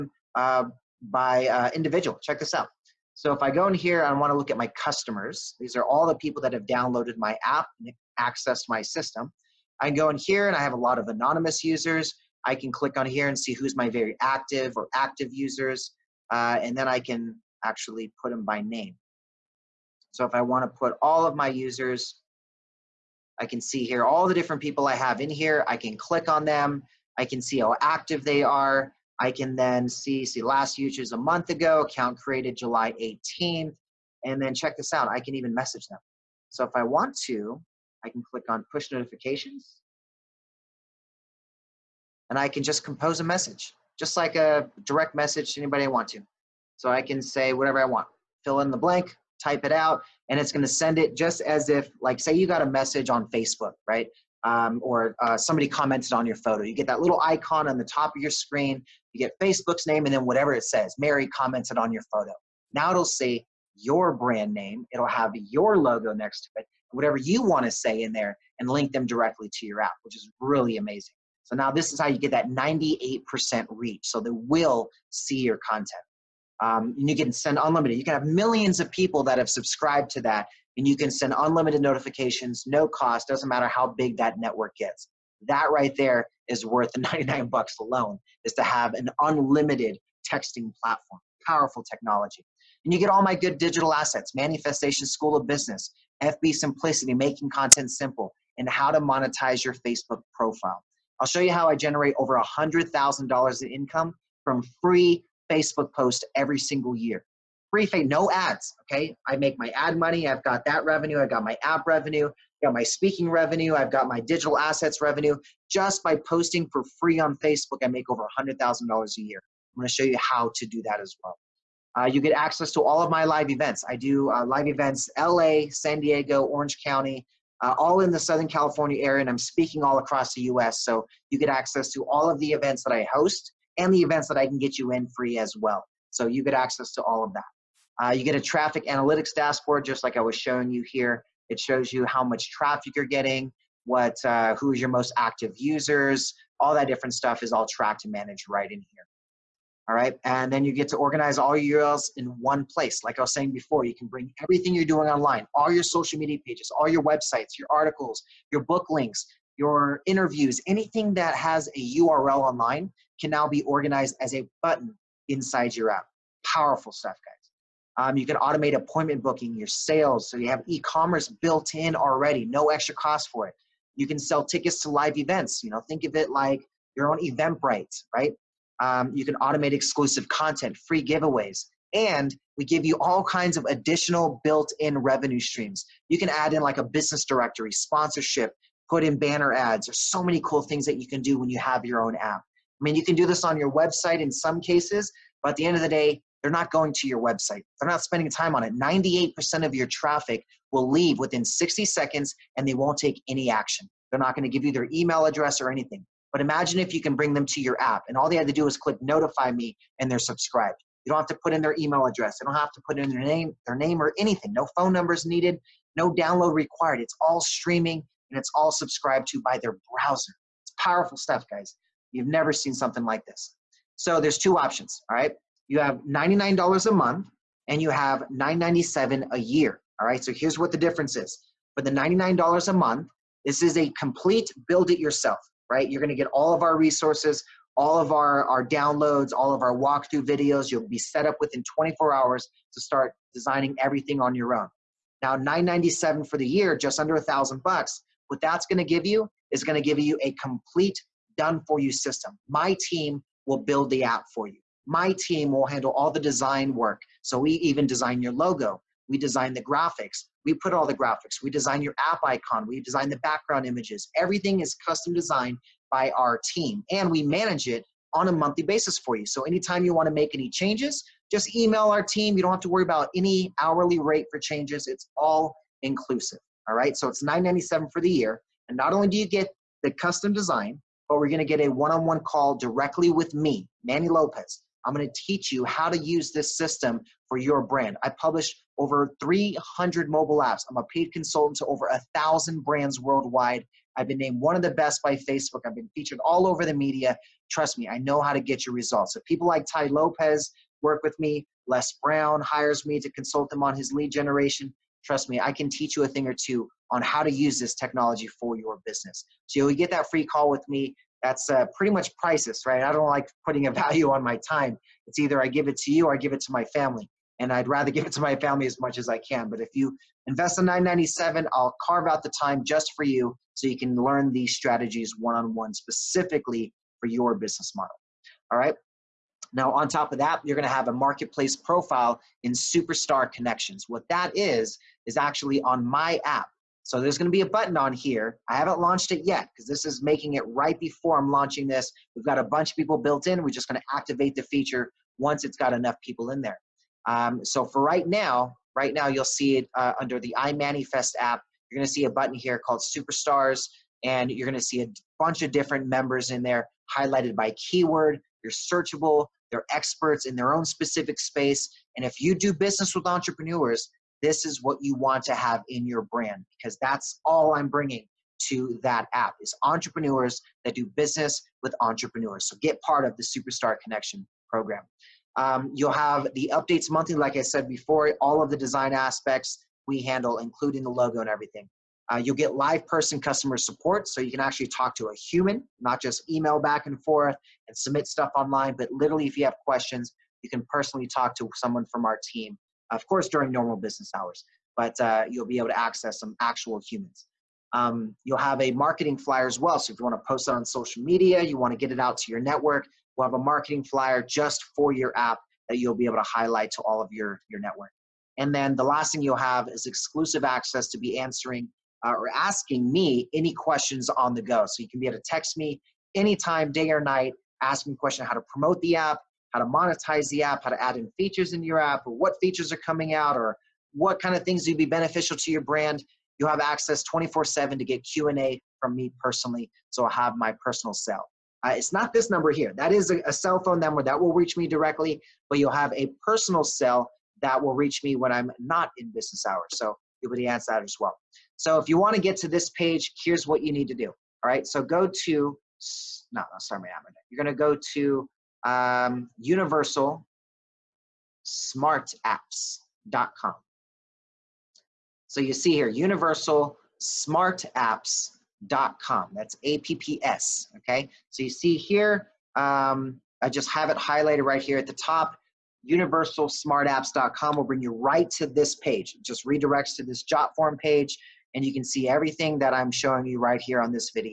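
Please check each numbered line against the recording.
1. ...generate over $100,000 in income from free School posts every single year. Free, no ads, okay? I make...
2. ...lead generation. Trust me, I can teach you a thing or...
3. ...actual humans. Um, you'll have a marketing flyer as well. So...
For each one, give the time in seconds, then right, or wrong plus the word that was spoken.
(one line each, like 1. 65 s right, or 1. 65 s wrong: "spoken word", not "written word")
1. 101 s wrong: "Facebook", not "School"
2. 303 s right
3. 396 s right.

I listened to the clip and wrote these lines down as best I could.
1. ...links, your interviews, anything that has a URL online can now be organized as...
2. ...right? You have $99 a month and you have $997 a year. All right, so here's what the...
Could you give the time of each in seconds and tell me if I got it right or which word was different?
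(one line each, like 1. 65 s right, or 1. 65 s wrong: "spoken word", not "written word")
1. 158 s right
2. 225 s right.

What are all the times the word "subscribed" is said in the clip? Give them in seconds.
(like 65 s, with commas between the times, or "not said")
79 s, 210 s, 218 s.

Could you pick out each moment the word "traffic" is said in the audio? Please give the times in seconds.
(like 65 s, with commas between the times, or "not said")
138 s, 142 s, 199 s.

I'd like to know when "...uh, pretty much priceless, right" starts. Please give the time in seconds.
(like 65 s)
311 s.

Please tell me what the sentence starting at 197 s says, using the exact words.
They're not spending time on it.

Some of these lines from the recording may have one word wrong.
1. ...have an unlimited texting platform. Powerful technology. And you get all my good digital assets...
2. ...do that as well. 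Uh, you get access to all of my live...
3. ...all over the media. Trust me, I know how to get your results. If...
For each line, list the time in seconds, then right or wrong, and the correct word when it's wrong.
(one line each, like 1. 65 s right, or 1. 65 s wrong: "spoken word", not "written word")
1. 88 s right
2. 120 s right
3. 296 s right.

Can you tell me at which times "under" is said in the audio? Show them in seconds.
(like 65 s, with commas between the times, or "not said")
246 s, 350 s.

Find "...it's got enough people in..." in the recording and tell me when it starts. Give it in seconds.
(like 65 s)
345 s.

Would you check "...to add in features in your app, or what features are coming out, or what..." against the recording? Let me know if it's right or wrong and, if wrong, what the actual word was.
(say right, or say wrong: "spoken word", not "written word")
right.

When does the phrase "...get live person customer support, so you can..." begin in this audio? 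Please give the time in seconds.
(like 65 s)
382 s.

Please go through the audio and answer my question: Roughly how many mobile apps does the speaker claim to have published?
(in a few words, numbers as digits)
Over 300.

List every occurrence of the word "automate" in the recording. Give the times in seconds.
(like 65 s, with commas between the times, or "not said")
168 s, 179 s.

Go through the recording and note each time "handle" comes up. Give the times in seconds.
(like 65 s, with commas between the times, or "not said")
255 s, 380 s.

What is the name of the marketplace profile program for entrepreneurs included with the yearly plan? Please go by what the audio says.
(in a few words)
Superstar Connections.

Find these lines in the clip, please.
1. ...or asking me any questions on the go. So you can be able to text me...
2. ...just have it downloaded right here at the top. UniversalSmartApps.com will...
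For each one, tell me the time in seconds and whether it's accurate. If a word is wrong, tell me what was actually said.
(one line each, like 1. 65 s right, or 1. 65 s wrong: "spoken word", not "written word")
1. 412 s right
2. 463 s wrong: "highlighted", not "downloaded".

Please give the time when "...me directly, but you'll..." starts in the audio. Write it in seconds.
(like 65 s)
434 s.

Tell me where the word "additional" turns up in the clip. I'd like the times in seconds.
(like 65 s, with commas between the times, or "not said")
183 s.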